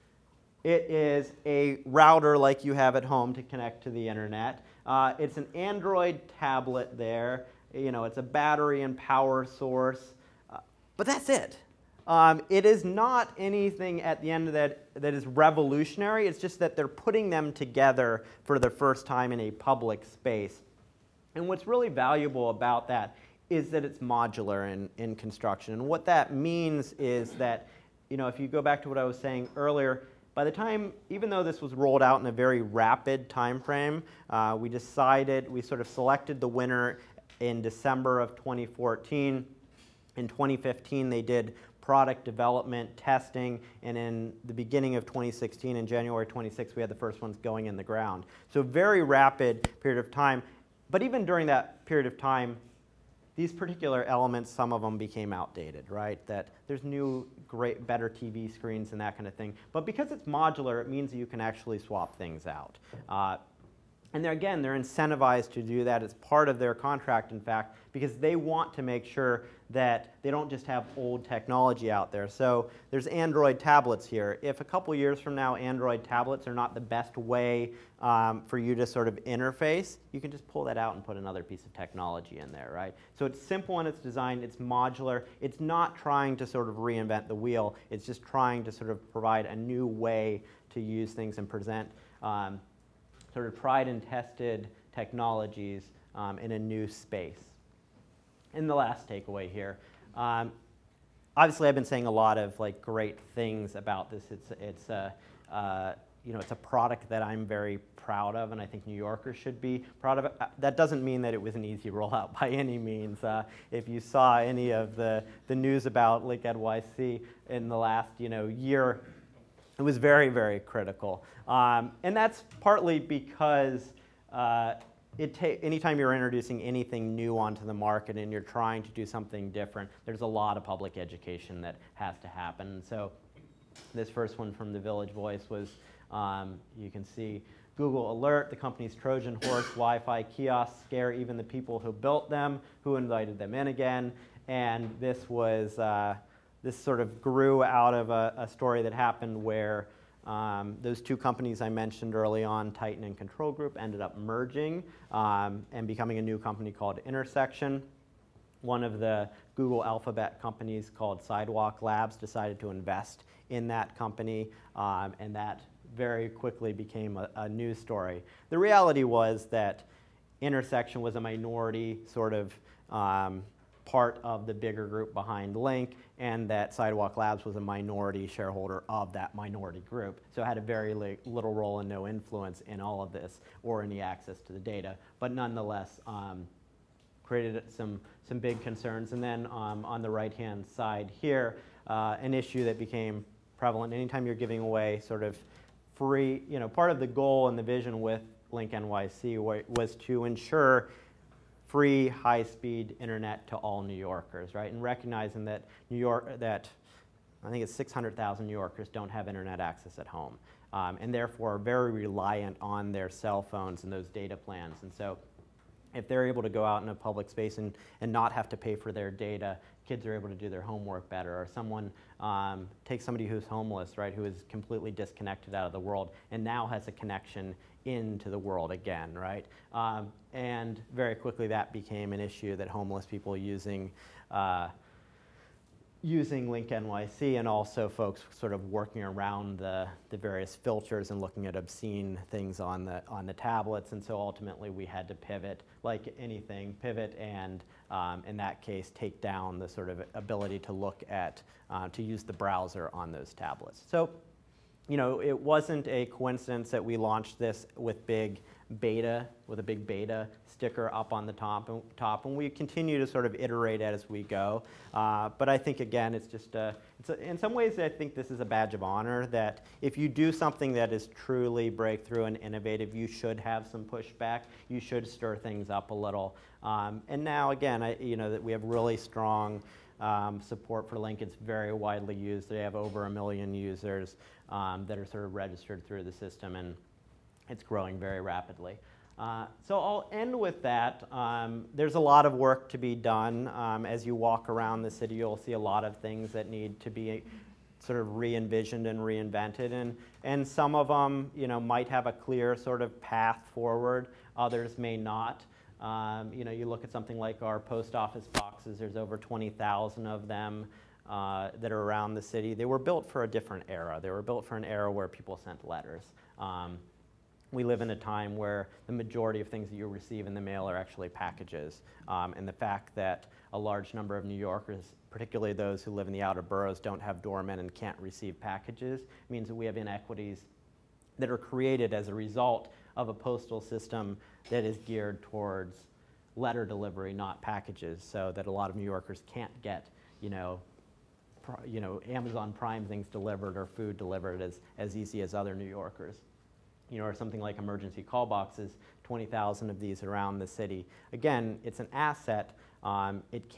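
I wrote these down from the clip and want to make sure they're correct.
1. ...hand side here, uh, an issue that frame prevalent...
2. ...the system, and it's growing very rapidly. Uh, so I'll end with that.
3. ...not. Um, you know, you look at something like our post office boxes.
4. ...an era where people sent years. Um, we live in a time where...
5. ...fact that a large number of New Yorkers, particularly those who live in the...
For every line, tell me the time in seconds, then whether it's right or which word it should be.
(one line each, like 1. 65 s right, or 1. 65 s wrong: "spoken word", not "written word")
1. 190 s wrong: "became", not "frame"
2. 286 s right
3. 304 s right
4. 314 s wrong: "letters", not "years"
5. 322 s right.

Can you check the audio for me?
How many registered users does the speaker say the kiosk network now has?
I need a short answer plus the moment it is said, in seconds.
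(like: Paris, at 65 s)
over a million, at 282 s.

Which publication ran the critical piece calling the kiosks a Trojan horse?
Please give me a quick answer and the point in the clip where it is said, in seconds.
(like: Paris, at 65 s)
Village Voice, at 134 s.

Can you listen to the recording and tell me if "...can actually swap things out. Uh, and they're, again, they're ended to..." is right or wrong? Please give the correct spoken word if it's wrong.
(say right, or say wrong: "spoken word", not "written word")
wrong: "incentivized", not "ended".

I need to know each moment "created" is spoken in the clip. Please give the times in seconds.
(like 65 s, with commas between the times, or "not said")
187 s, 331 s.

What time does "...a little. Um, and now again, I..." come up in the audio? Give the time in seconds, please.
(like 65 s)
275 s.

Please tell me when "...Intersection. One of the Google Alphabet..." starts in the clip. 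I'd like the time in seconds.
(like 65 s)
157 s.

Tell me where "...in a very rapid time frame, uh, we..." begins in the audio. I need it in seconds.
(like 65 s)
32 s.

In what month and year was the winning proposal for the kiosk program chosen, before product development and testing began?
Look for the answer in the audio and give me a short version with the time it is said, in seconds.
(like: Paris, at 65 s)
December 2014, at 37 s.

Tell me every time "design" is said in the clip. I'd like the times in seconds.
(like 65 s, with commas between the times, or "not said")
83 s.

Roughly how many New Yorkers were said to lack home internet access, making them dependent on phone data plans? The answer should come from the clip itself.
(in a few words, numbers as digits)
600,000.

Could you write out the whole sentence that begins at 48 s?
So, very rapid period of time.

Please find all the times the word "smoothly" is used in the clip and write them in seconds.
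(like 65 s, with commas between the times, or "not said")
not said.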